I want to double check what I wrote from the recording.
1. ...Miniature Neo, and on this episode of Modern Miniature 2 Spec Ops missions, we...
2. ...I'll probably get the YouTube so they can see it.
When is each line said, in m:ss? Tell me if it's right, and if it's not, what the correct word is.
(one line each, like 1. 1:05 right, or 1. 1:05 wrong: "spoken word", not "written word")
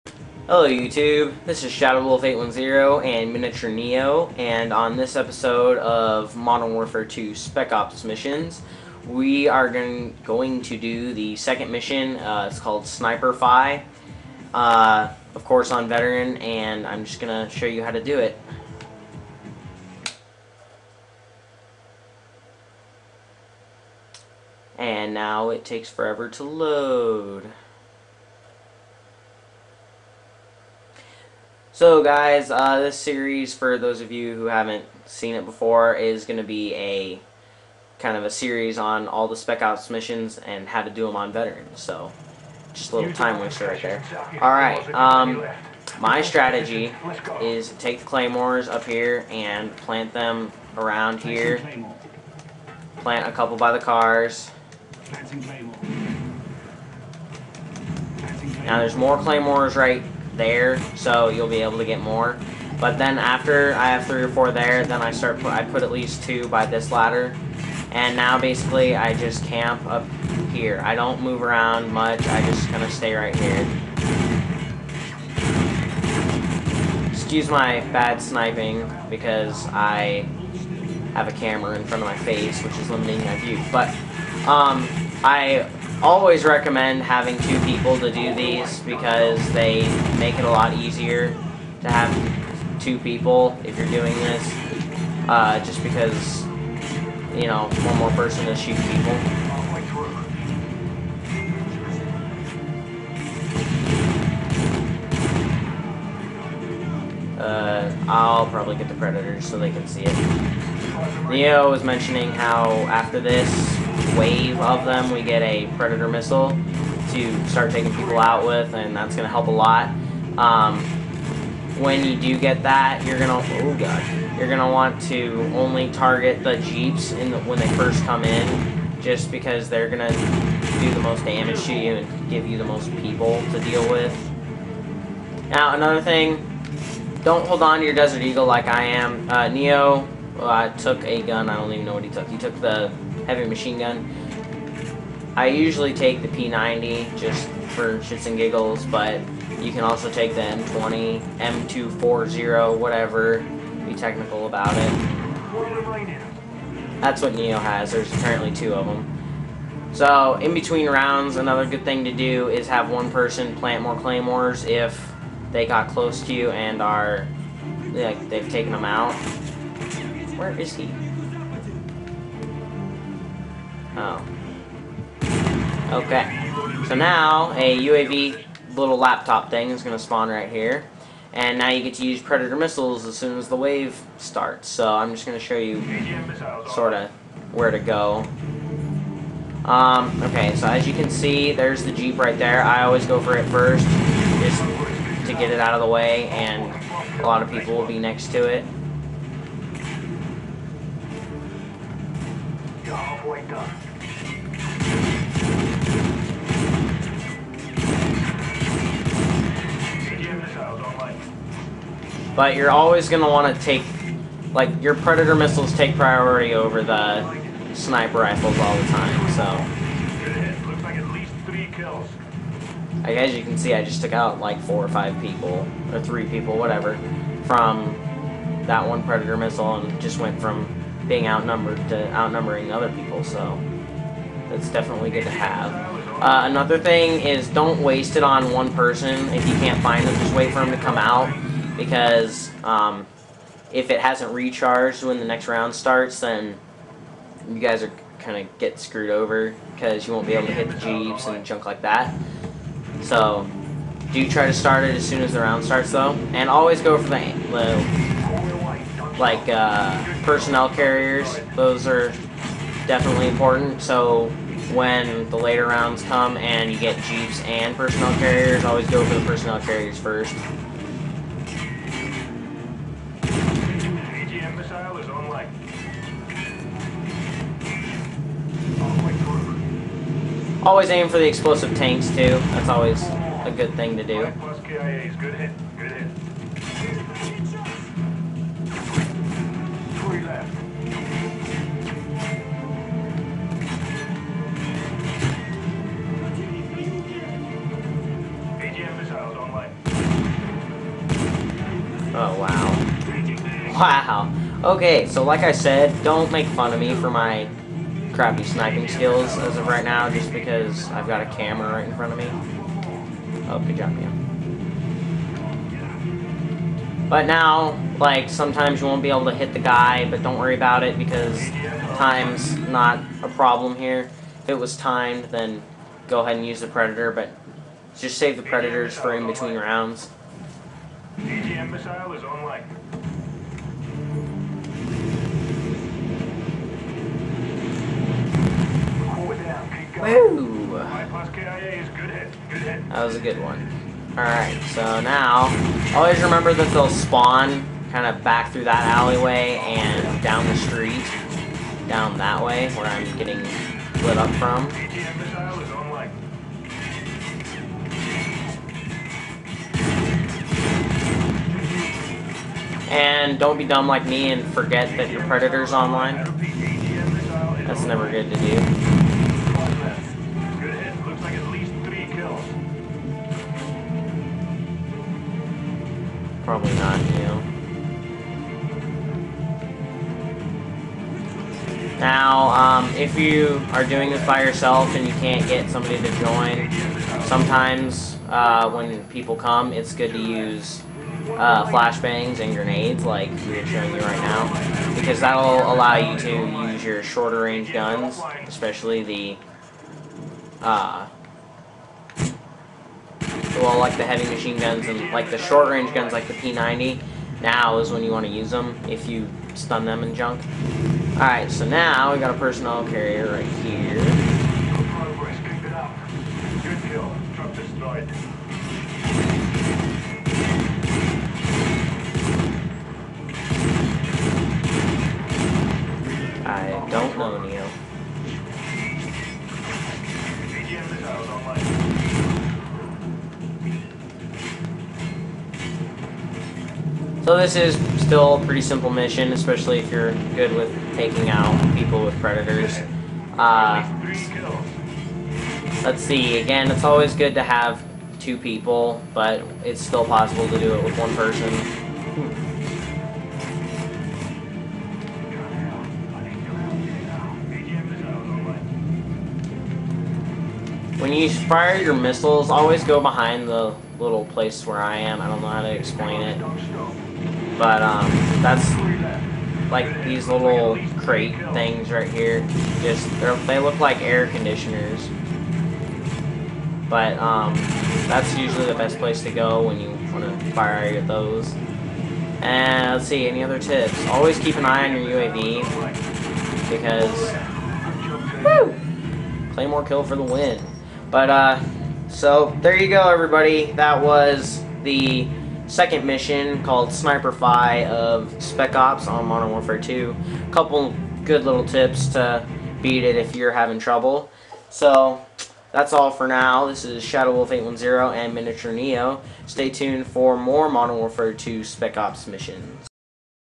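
1. 0:03 wrong: "Warfare", not "Miniature"
2. 1:48 wrong: "Predators", not "YouTube".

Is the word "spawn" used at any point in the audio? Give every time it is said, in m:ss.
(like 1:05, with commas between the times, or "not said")
3:00, 5:46.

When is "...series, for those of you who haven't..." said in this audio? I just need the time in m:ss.
0:32.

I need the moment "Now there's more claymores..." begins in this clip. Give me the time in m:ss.
0:58.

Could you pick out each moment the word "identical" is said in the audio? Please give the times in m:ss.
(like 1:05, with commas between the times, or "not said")
not said.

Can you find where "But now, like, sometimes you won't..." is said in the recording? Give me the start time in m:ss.
5:17.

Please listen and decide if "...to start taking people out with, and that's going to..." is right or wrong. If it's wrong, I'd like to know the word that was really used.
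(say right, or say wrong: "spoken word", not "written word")
right.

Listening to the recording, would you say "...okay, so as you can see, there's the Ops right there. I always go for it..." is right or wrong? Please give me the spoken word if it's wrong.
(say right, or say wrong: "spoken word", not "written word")
wrong: "Jeep", not "Ops".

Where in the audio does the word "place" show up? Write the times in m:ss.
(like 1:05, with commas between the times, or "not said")
7:44, 7:58.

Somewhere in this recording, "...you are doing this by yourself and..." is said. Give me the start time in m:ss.
6:23.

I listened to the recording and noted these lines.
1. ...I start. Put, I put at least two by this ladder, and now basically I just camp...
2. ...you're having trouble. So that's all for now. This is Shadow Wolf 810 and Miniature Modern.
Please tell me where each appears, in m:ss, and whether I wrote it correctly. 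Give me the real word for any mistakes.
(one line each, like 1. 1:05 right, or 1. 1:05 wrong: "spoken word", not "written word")
1. 1:05 right
2. 8:23 wrong: "Neo", not "Modern".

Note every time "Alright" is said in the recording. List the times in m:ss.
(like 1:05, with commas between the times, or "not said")
0:44, 5:44, 6:51.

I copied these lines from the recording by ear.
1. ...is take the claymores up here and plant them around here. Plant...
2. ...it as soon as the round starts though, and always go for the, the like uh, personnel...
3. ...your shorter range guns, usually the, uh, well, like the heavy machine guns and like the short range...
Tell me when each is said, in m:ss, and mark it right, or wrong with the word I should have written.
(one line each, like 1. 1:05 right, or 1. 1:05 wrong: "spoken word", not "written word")
1. 0:47 right
2. 4:14 right
3. 6:36 wrong: "especially", not "usually".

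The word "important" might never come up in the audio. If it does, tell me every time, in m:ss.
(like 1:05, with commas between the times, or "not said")
4:23.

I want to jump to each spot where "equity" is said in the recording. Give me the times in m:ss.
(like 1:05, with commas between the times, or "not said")
not said.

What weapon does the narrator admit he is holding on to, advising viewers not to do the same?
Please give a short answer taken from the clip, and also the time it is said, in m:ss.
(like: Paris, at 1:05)
Desert Eagle, at 2:17.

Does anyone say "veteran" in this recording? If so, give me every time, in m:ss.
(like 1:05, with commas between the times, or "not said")
0:15, 0:41.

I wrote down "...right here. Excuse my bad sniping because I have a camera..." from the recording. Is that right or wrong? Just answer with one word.
right.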